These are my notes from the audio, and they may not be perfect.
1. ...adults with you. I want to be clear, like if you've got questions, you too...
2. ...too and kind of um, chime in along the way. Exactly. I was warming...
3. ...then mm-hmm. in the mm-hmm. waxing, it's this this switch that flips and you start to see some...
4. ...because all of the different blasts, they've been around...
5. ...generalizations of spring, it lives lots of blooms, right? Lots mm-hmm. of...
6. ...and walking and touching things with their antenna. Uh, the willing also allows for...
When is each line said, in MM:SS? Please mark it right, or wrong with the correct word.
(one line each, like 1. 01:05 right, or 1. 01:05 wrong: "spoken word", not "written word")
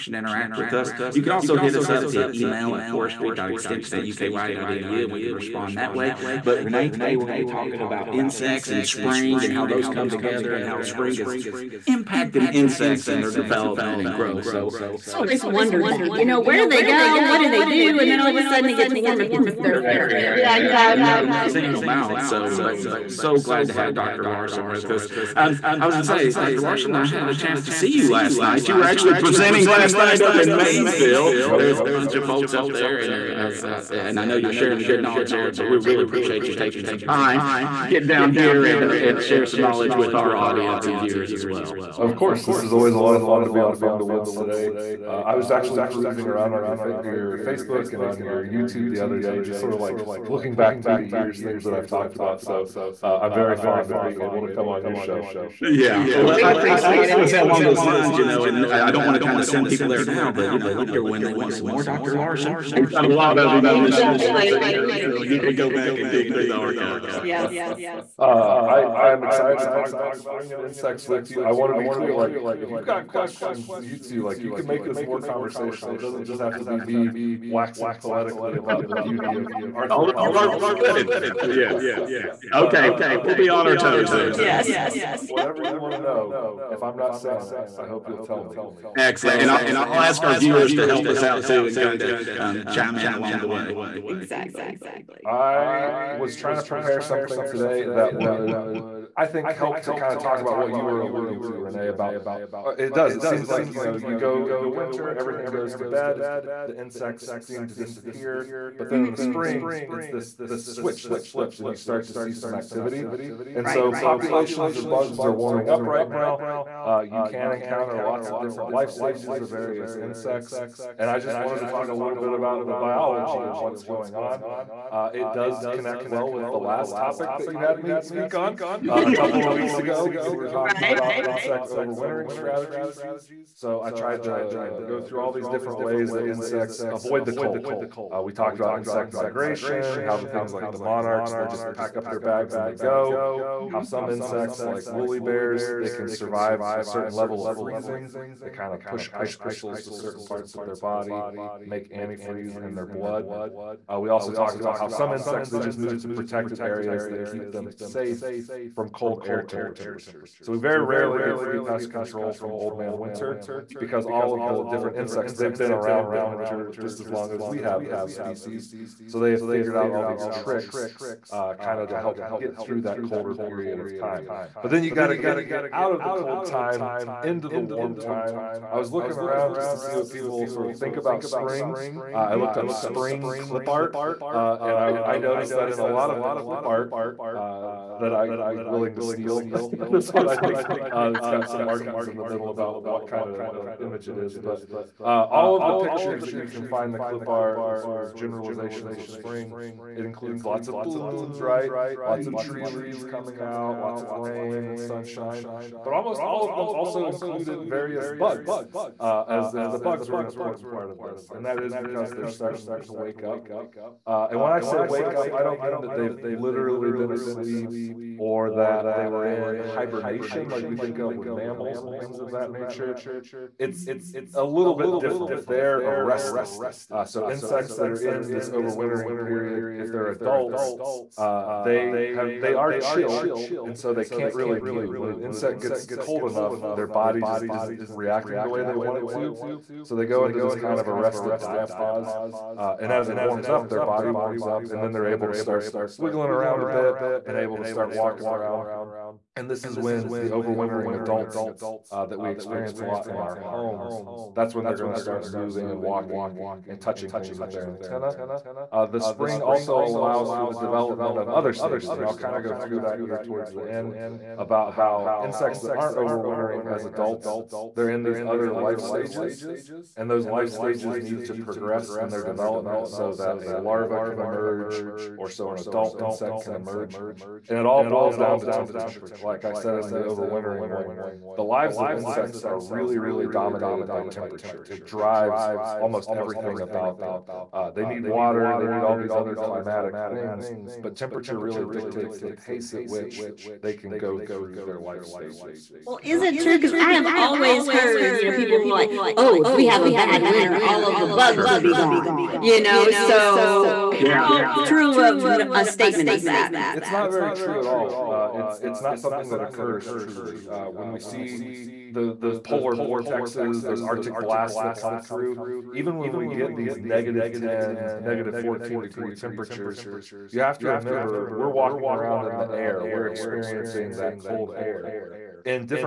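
1. 01:10 wrong: "insects", not "adults"
2. 01:31 wrong: "trying", not "warming"
3. 01:48 wrong: "spring", not "waxing"
4. 02:43 wrong: "insects", not "blasts"
5. 03:18 wrong: "includes", not "lives"
6. 04:15 wrong: "spring", not "willing".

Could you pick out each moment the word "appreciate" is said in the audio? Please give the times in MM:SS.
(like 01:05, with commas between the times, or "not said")
00:36, 00:56.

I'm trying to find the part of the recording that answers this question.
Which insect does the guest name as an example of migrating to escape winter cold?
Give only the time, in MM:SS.
02:20.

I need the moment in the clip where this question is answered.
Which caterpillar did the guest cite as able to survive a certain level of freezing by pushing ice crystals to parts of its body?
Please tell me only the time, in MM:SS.
02:24.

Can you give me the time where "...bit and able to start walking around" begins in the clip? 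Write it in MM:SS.
04:06.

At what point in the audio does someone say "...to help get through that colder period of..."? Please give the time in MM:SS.
02:51.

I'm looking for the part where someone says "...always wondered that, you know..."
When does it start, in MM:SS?
00:15.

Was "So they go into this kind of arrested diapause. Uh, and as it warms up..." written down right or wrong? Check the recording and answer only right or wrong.
right.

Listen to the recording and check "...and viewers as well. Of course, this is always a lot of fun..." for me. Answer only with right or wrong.
right.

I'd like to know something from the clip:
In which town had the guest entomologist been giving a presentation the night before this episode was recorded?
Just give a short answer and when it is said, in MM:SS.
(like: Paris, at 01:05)
Maysville, at 00:30.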